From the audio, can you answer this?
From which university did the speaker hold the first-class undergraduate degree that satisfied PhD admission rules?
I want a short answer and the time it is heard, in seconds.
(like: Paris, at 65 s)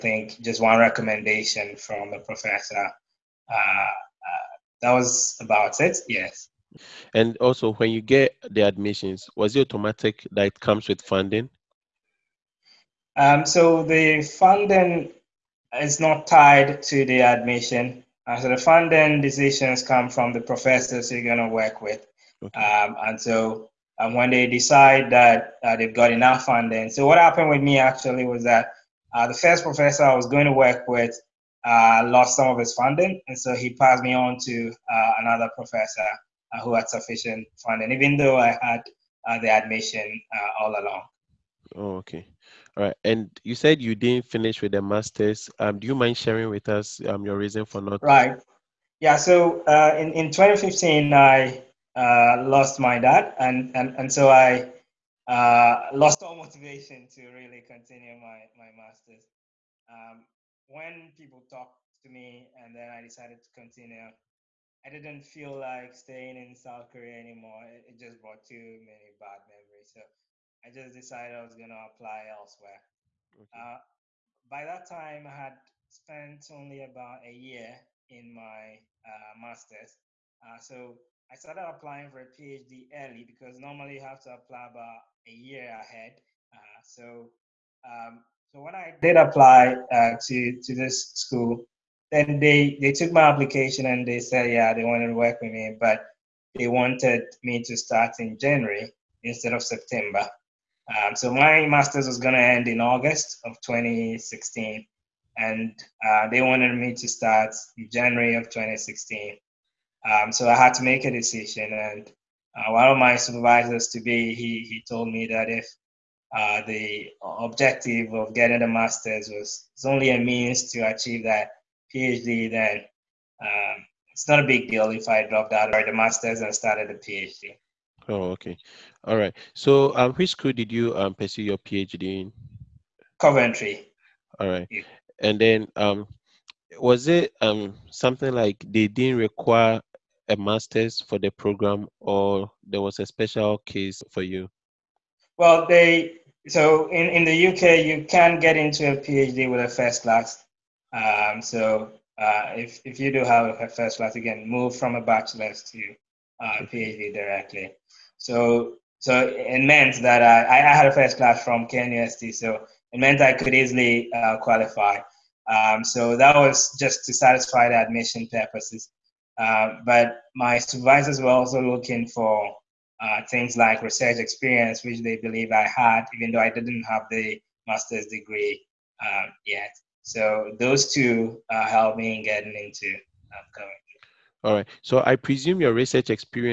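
KNUST, at 161 s.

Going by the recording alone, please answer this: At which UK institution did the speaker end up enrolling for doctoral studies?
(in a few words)
Coventry.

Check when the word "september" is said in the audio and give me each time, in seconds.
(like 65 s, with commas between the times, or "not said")
99 s.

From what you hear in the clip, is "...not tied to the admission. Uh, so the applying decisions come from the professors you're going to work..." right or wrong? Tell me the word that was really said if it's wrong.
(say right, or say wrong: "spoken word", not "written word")
wrong: "funding", not "applying".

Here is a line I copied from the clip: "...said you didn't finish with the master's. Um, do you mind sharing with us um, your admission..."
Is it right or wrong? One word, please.
wrong.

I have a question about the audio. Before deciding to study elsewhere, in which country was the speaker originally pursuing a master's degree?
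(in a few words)
South Korea.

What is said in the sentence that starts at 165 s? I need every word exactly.
Um, so that was just to satisfy the admission purposes.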